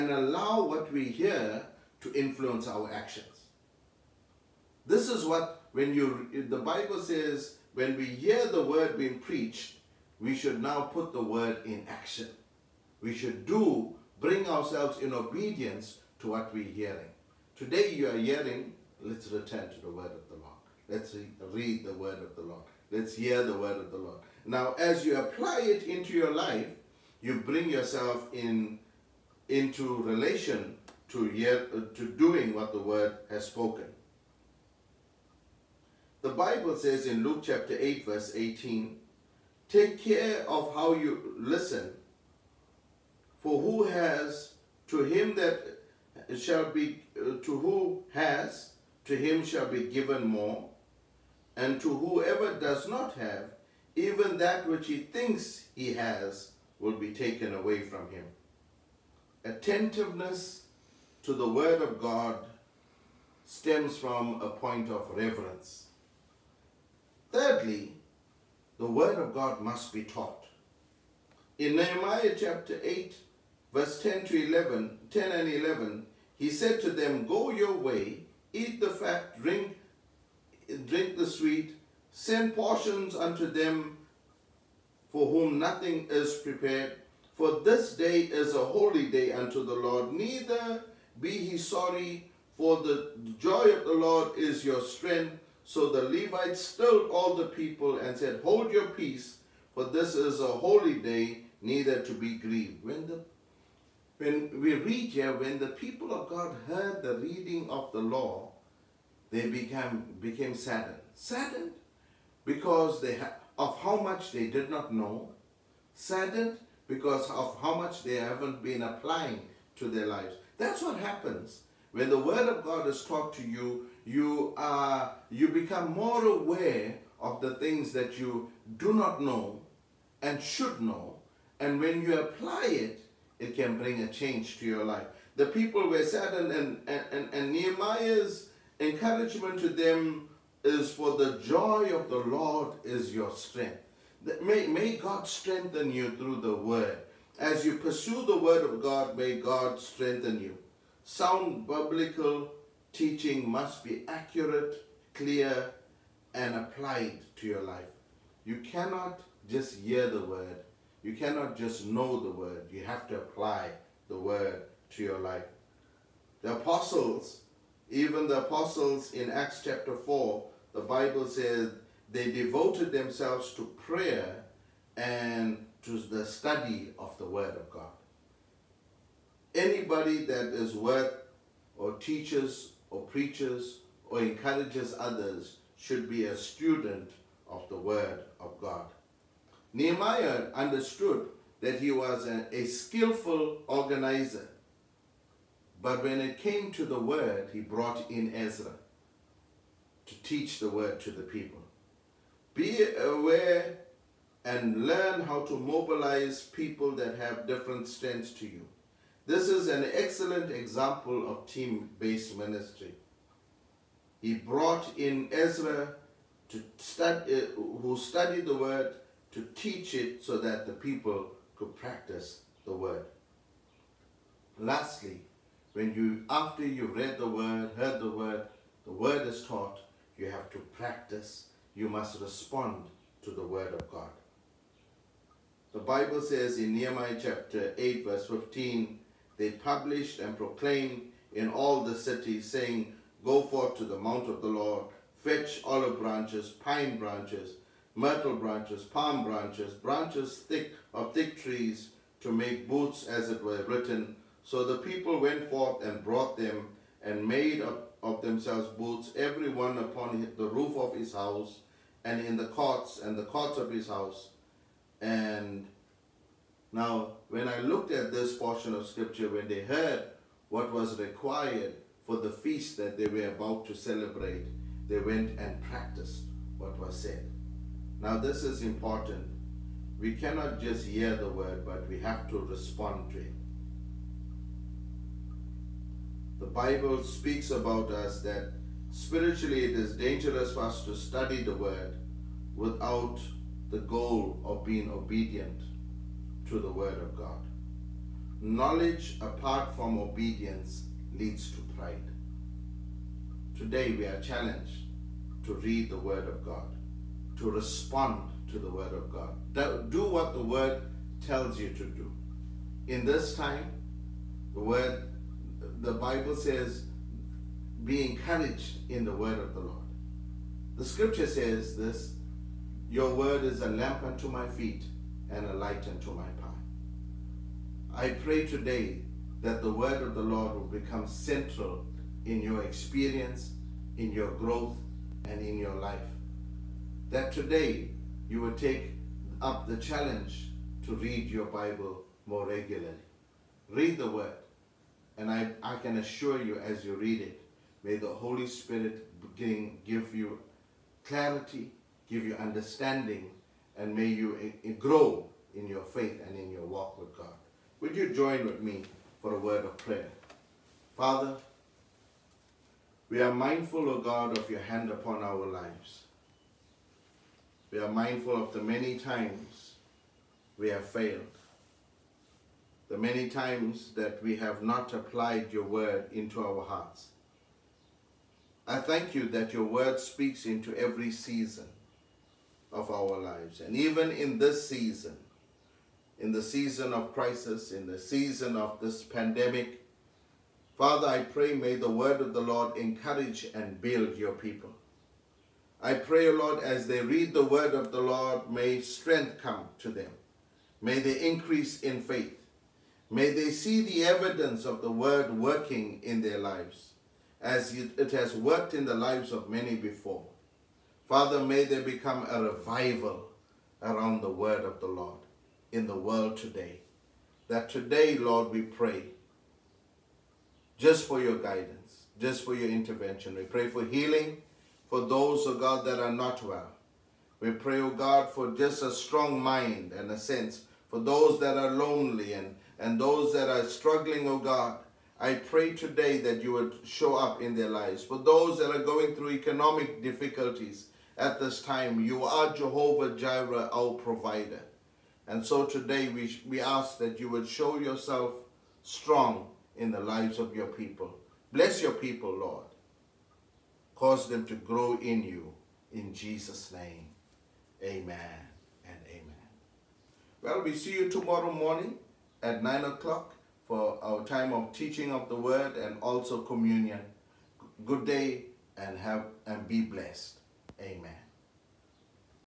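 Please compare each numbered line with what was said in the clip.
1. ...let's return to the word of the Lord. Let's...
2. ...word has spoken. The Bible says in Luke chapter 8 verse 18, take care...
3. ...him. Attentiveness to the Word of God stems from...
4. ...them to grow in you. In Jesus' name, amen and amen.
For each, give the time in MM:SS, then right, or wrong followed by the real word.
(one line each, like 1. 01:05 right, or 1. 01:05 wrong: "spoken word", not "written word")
1. 00:19 right
2. 00:32 right
3. 00:58 right
4. 07:34 right.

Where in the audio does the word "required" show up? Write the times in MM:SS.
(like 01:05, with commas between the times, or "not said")
04:30.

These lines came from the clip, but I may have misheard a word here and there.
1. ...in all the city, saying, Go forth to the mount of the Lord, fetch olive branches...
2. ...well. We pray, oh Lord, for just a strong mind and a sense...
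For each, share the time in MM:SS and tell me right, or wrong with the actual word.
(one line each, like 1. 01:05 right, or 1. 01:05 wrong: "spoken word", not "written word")
1. 04:01 right
2. 07:06 wrong: "God", not "Lord".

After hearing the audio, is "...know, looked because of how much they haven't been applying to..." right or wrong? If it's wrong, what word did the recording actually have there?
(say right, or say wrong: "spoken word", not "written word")
wrong: "saddened", not "looked".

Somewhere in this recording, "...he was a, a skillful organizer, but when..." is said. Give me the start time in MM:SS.
03:11.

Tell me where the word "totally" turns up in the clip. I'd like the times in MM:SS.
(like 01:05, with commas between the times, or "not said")
not said.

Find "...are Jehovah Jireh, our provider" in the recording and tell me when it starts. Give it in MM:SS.
07:22.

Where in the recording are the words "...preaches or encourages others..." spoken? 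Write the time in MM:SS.
03:03.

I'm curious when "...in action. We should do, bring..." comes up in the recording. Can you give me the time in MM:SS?
00:11.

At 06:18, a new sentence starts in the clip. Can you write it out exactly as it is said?
I thank you that your word speaks into every season of our lives.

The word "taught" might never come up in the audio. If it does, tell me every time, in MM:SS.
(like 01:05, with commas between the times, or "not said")
01:10, 02:03, 03:49.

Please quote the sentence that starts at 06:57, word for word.
That today, Lord, we pray just for your guidance, just for your intervention.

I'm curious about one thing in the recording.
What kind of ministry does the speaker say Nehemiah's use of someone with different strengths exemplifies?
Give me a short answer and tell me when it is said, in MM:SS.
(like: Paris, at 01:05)
Team-based ministry, at 03:31.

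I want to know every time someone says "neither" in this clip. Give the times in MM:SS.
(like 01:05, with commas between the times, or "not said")
01:30, 01:41.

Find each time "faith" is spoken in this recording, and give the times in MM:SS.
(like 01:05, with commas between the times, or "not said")
05:55, 06:42.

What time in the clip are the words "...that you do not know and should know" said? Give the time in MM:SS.
02:07.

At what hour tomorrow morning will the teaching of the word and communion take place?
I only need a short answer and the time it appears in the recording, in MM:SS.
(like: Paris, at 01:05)
9 o'clock, at 07:42.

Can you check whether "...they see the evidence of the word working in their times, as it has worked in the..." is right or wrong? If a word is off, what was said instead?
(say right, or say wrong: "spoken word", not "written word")
wrong: "lives", not "times".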